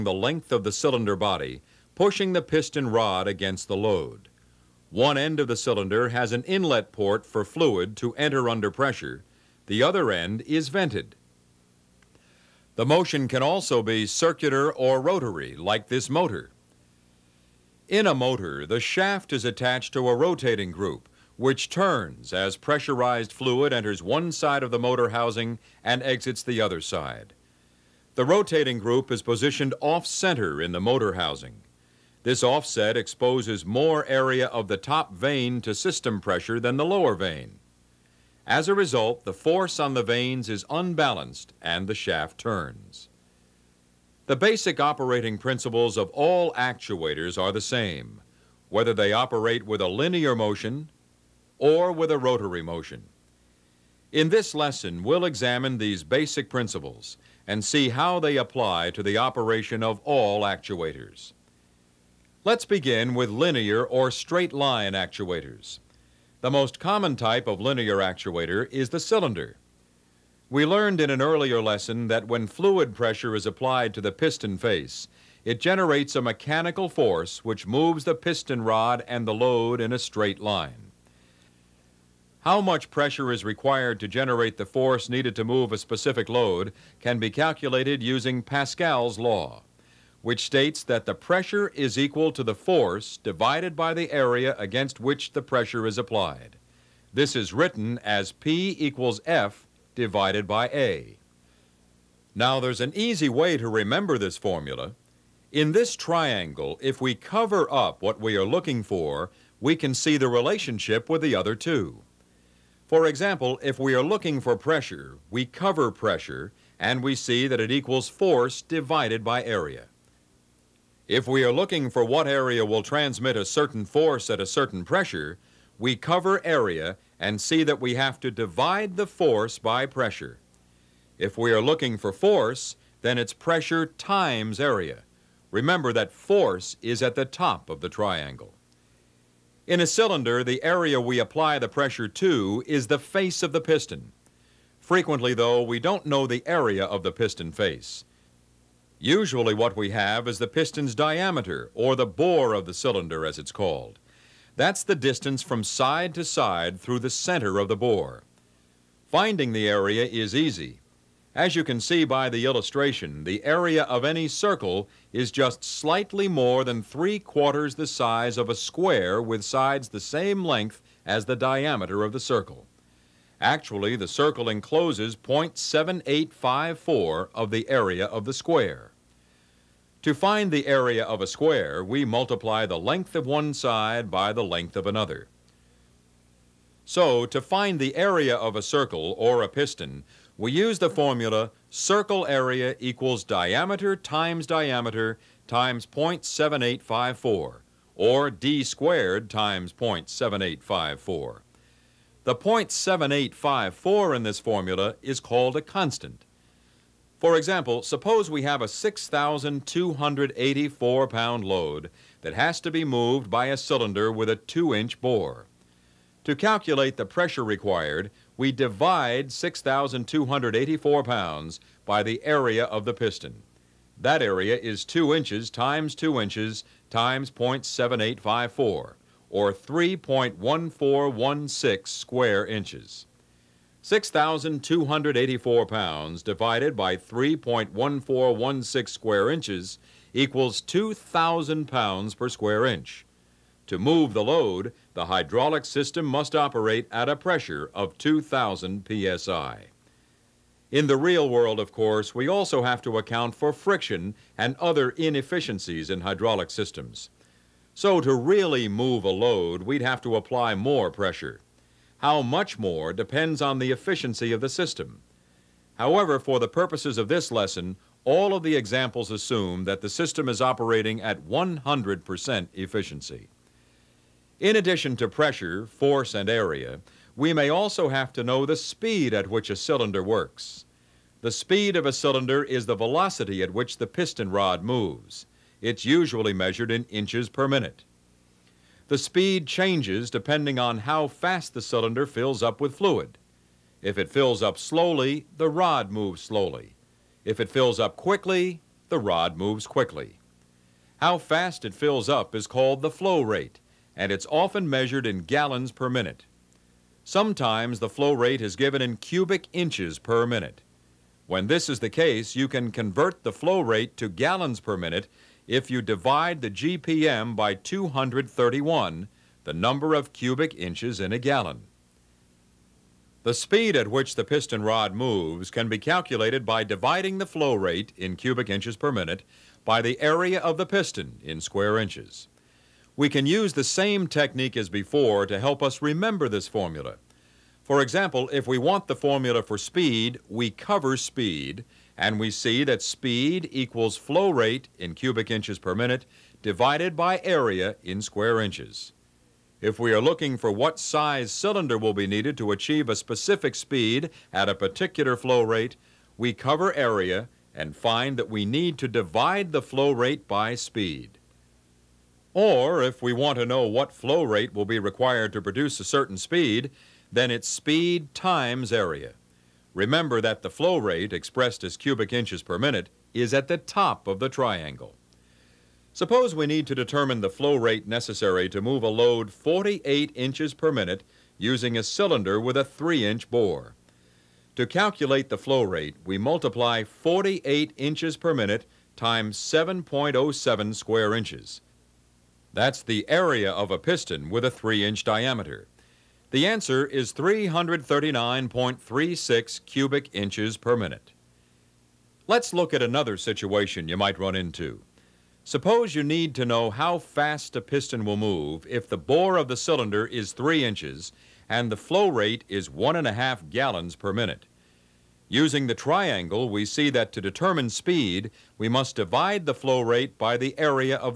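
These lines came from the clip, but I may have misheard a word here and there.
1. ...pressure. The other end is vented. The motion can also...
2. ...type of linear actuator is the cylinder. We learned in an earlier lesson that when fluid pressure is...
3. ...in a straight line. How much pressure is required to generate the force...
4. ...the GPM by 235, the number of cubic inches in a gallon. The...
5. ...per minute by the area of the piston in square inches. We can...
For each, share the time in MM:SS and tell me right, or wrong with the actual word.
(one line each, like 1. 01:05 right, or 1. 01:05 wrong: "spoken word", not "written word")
1. 00:08 right
2. 01:07 right
3. 01:19 right
4. 05:16 wrong: "231", not "235"
5. 05:28 right.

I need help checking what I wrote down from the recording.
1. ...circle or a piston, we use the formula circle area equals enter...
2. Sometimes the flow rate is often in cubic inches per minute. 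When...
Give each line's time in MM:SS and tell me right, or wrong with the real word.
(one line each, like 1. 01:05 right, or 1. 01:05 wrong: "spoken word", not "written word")
1. 03:08 wrong: "diameter", not "enter"
2. 05:07 wrong: "given", not "often".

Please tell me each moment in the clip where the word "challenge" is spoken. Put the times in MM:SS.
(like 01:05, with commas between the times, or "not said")
not said.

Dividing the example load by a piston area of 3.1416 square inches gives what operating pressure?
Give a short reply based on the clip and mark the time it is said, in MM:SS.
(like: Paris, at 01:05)
2,000 psi, at 04:00.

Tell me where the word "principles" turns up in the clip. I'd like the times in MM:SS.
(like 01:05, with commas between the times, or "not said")
00:45, 00:56.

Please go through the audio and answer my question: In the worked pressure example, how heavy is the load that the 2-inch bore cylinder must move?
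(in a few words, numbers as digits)
6,284 pounds.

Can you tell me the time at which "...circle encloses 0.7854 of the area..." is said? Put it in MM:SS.
02:54.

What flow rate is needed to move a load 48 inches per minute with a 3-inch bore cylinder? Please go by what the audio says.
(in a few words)
339.36 cubic inches per minute.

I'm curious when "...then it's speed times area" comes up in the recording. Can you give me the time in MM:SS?
06:07.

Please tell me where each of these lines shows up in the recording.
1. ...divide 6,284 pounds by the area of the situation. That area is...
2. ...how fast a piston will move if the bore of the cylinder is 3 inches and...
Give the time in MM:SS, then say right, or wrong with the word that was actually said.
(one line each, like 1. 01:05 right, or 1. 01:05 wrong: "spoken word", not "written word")
1. 03:38 wrong: "piston", not "situation"
2. 06:46 right.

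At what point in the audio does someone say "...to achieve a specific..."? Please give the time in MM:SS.
05:52.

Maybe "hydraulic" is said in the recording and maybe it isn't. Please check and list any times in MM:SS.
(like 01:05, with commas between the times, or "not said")
04:05, 04:16.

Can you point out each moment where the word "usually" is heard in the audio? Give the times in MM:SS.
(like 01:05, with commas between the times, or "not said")
02:29, 04:45.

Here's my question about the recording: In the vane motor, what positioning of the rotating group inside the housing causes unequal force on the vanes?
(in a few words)
off-center.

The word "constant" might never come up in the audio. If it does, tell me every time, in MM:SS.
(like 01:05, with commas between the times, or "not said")
03:25.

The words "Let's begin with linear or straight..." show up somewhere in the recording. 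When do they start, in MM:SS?
01:02.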